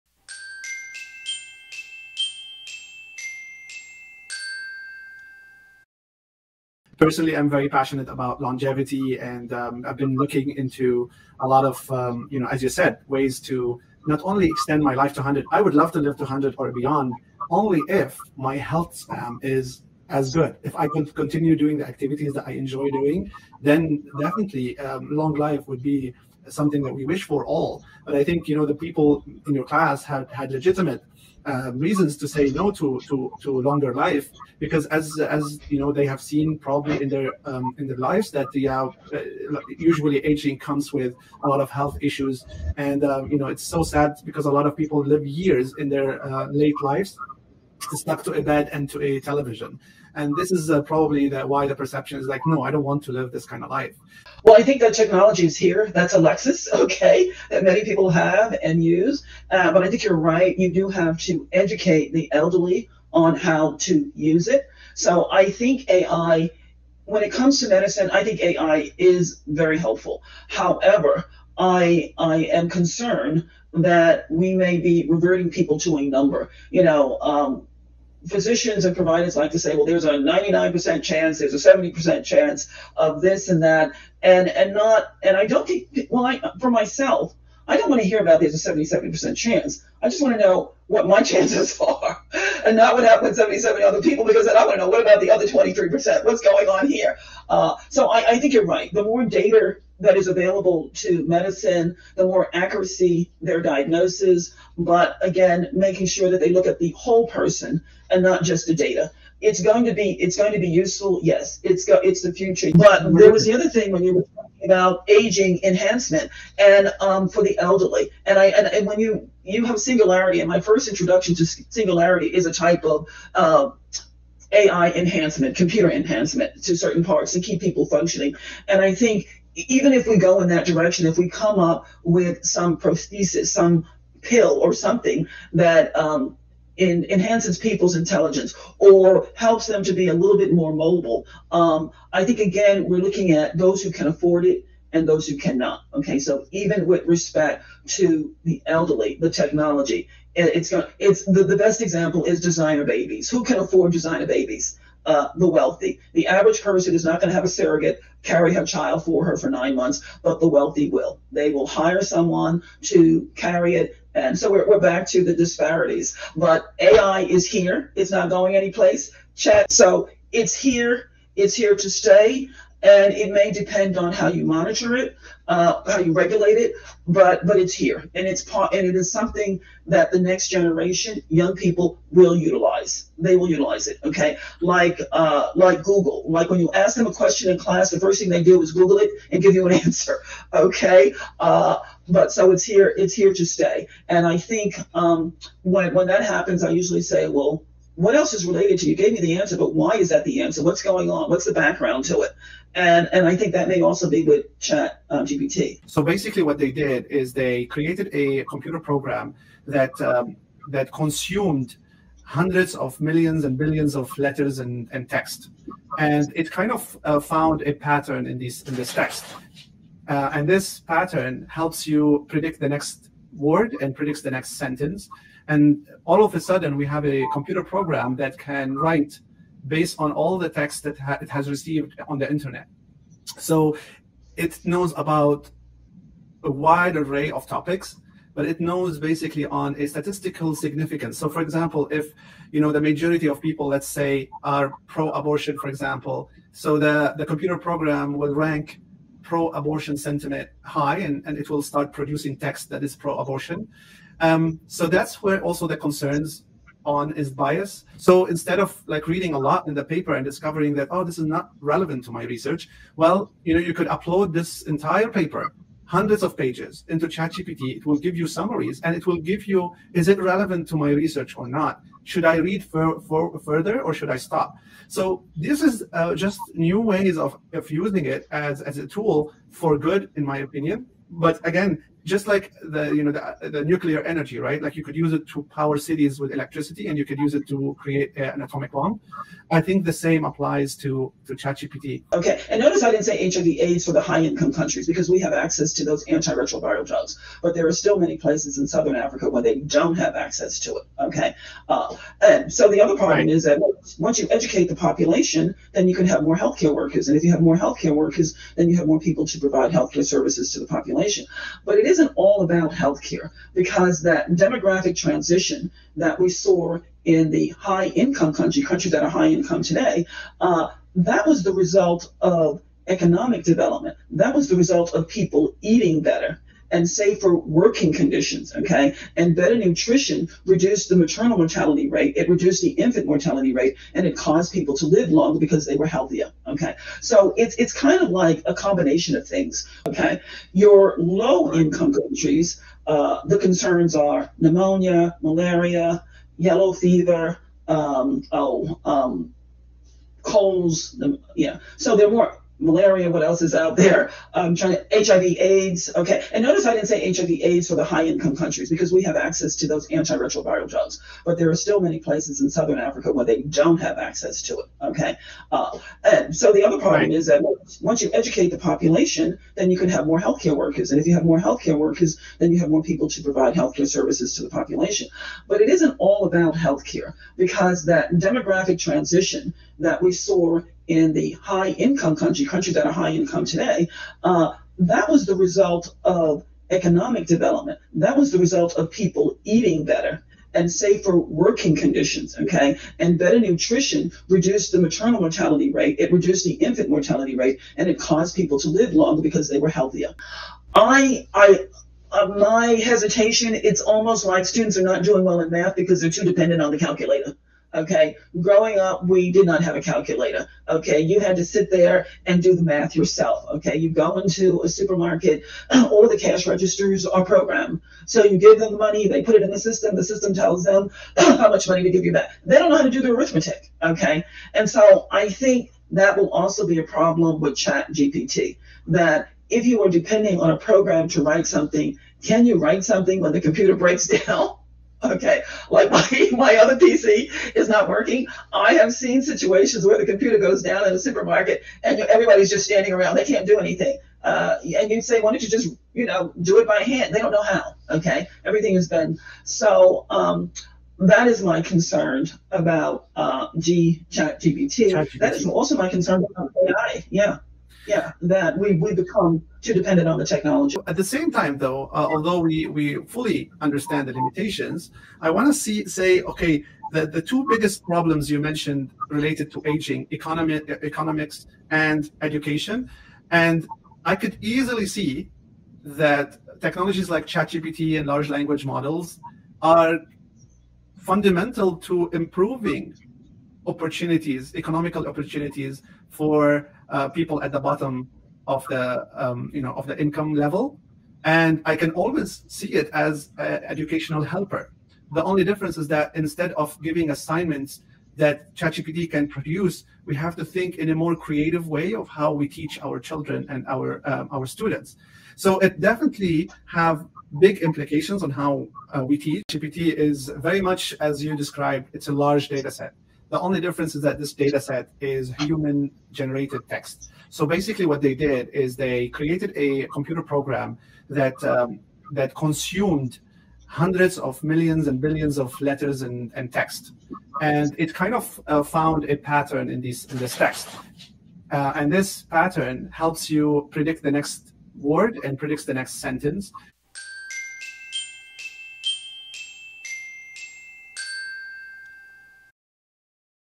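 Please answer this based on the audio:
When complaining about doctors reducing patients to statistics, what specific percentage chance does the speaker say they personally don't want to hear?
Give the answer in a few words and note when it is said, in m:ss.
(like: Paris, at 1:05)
77%, at 1:28.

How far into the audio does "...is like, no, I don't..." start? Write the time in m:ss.
0:52.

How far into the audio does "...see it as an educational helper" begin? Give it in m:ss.
8:12.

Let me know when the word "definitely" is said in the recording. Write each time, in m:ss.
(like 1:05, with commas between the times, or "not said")
0:24, 8:25.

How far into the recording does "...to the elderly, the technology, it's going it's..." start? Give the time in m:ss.
2:27.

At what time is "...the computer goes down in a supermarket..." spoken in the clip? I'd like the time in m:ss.
7:19.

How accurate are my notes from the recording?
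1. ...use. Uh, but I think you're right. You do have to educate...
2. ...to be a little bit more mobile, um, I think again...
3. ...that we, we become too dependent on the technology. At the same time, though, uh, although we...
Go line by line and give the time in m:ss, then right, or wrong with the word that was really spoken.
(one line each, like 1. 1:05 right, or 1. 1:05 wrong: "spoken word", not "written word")
1. 0:58 right
2. 2:19 right
3. 7:38 right.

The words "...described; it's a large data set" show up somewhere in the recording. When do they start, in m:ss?
8:31.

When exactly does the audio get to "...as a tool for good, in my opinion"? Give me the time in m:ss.
4:38.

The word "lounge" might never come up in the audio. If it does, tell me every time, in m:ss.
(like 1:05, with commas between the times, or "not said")
not said.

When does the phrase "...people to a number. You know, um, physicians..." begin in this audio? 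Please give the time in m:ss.
1:15.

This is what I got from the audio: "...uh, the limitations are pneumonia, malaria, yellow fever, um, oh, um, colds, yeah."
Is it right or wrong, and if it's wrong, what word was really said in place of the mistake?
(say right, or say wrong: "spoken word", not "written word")
wrong: "concerns", not "limitations".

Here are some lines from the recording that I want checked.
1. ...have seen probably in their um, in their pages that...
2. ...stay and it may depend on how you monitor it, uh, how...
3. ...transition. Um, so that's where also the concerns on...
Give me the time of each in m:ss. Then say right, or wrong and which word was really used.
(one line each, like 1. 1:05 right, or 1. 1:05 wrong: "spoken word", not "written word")
1. 0:36 wrong: "lives", not "pages"
2. 2:51 right
3. 4:13 wrong: "abortion", not "transition".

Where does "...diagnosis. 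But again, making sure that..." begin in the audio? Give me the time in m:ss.
1:43.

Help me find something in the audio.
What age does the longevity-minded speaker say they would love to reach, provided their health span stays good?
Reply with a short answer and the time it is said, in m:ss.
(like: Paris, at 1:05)
100, at 0:14.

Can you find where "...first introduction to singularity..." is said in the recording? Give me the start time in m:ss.
2:00.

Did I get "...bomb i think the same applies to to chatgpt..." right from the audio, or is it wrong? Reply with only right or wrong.
right.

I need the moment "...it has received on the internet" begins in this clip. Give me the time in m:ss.
3:51.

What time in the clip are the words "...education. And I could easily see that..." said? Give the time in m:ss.
7:52.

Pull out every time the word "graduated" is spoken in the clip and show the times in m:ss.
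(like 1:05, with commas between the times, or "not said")
not said.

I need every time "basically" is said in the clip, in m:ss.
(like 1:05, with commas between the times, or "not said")
3:26, 3:58, 8:37.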